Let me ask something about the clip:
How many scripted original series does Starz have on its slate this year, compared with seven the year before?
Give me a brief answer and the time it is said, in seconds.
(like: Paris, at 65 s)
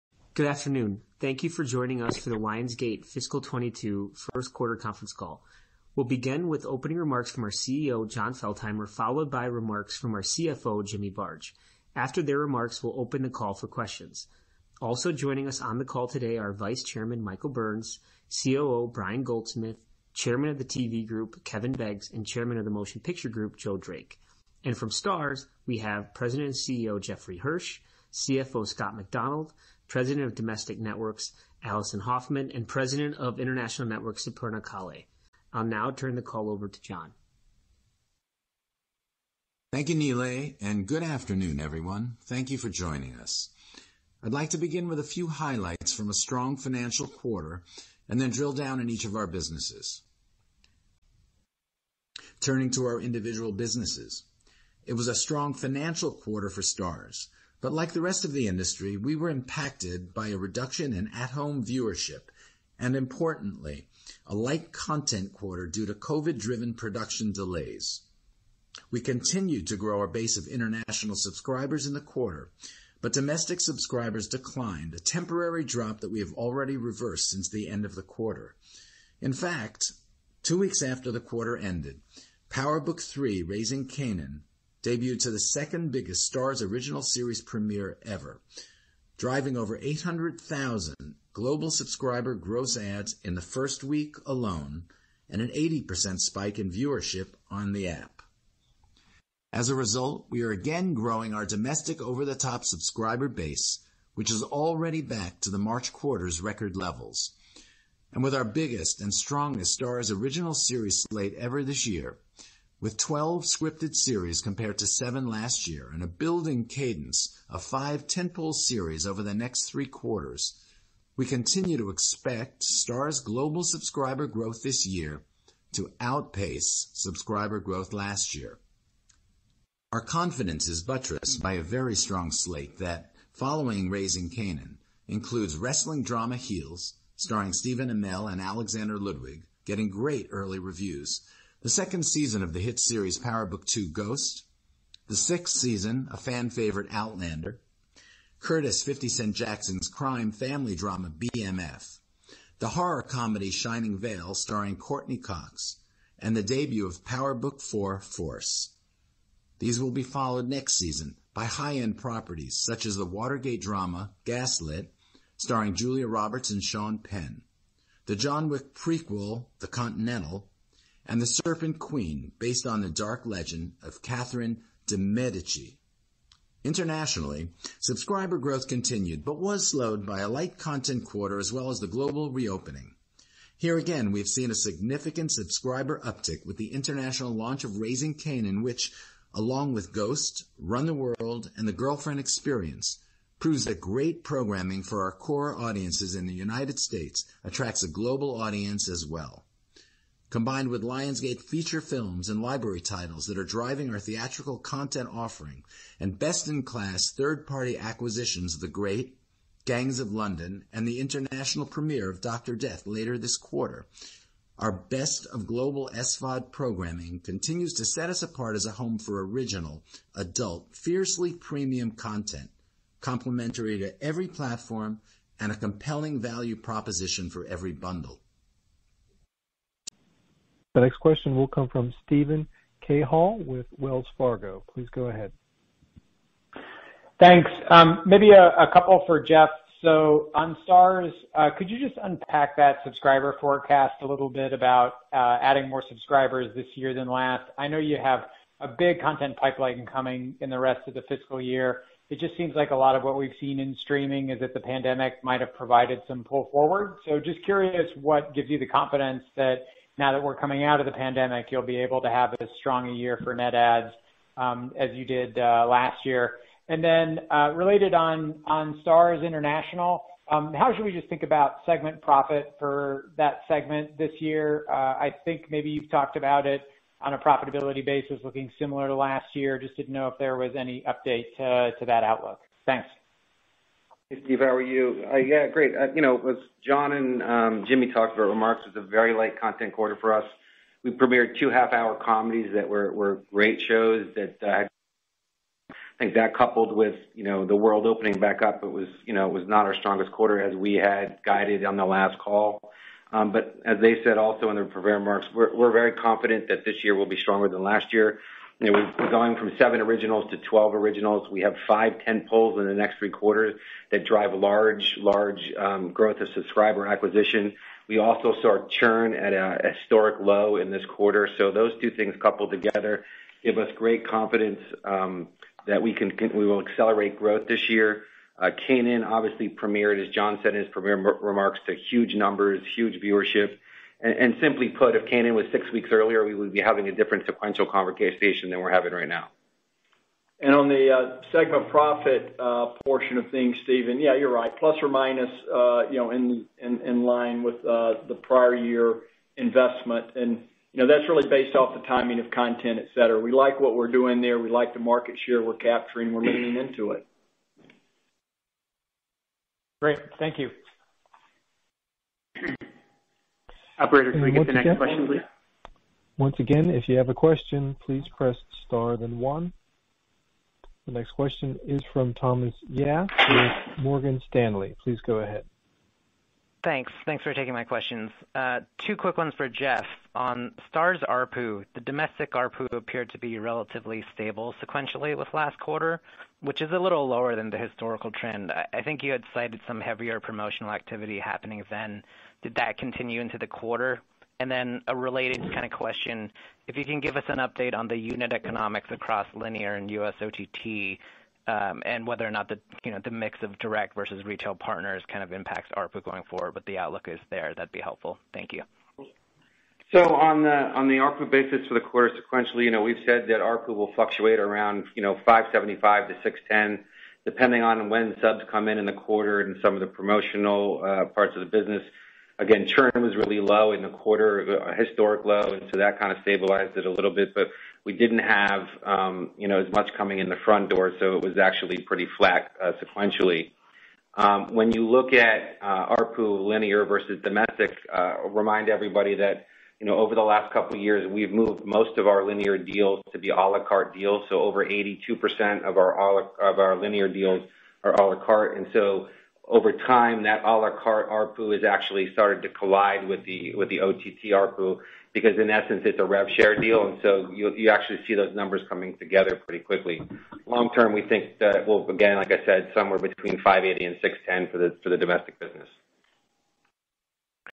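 12, at 112 s.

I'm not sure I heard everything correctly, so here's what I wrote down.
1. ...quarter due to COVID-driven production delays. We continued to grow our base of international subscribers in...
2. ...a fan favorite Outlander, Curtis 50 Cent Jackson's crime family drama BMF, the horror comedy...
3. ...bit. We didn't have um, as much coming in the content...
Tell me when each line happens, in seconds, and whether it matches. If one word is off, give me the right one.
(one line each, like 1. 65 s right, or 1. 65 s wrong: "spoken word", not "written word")
1. 65 s right
2. 146 s right
3. 427 s wrong: "front", not "content".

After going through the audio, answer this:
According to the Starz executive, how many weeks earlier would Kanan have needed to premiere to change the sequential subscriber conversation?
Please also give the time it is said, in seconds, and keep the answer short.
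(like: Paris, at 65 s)
6, at 335 s.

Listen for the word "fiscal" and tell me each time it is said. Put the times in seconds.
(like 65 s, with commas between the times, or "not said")
3 s, 251 s.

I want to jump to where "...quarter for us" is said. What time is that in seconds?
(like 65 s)
289 s.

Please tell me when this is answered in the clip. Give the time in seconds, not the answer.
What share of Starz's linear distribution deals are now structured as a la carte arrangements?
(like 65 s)
444 s.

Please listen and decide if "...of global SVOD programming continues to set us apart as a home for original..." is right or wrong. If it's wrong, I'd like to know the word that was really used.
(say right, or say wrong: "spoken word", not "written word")
right.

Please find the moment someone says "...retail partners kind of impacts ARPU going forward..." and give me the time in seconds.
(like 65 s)
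404 s.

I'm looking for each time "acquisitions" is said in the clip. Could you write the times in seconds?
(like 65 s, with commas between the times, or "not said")
207 s, 316 s.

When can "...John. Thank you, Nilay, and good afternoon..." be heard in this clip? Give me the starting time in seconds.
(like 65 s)
36 s.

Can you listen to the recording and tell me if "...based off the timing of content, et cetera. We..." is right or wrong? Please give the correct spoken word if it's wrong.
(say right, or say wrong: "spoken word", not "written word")
right.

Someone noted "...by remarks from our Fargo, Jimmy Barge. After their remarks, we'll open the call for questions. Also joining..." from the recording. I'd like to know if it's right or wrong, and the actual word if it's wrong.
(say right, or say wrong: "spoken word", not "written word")
wrong: "CFO", not "Fargo".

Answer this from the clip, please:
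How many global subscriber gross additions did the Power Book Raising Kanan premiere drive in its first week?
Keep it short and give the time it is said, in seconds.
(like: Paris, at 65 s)
800,000, at 89 s.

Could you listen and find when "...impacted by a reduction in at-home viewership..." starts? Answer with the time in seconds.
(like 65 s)
59 s.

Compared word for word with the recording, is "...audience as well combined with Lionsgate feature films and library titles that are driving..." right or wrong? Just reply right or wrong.
right.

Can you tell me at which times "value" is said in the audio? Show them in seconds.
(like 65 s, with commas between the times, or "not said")
226 s.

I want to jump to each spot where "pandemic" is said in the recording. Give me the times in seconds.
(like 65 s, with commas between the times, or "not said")
254 s, 260 s.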